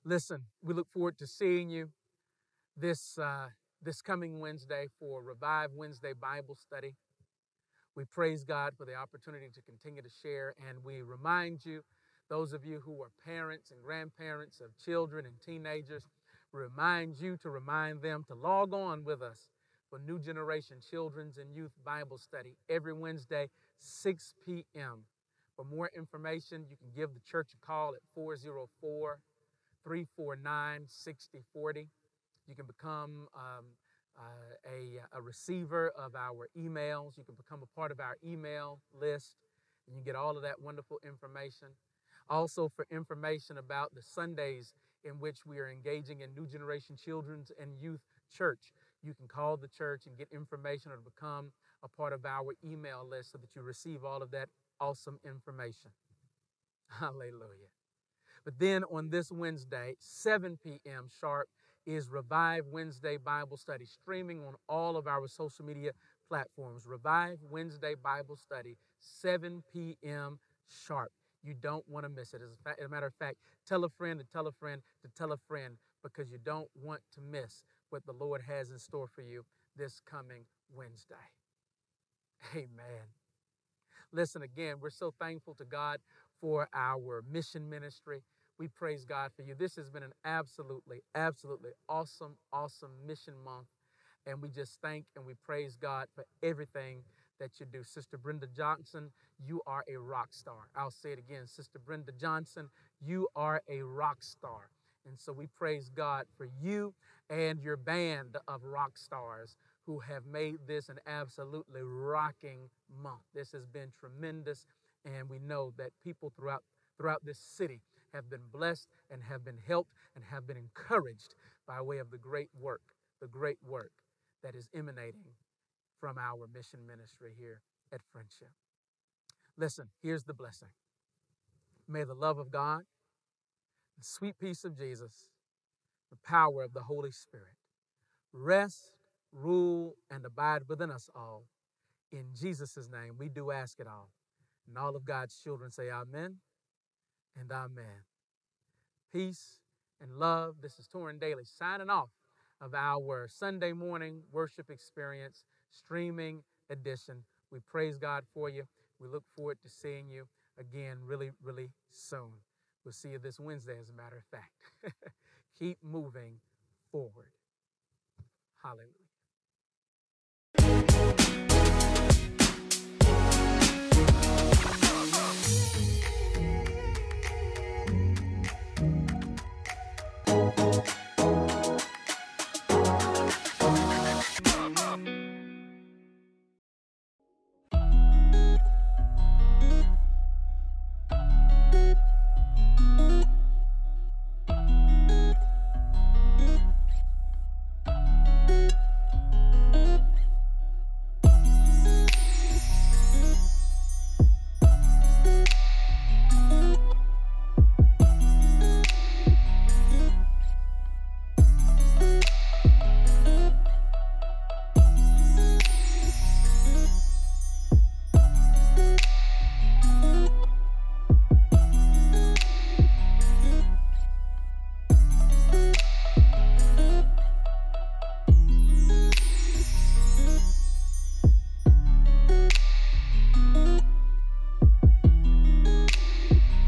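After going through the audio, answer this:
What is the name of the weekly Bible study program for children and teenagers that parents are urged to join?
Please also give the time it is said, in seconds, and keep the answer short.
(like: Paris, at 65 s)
New Generation Children's and Youth Bible Study, at 19 s.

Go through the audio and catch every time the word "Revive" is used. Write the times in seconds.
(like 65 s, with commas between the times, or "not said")
5 s, 62 s, 66 s.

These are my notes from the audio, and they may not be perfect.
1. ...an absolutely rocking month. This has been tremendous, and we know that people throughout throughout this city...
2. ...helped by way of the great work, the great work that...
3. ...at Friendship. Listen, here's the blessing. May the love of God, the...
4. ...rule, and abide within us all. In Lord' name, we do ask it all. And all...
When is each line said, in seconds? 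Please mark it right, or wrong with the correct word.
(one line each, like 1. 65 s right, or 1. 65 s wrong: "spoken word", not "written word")
1. 110 s right
2. 120 s wrong: "encouraged", not "helped"
3. 127 s right
4. 139 s wrong: "Jesus", not "Lord".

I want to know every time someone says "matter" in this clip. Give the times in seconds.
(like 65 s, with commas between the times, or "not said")
72 s, 163 s.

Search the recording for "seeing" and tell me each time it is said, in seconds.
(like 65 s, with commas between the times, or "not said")
1 s, 159 s.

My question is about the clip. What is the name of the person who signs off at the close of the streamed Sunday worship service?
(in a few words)
Torin Dailey.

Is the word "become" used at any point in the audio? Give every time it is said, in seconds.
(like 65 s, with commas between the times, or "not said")
32 s, 37 s, 50 s.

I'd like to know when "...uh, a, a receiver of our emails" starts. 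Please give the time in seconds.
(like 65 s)
34 s.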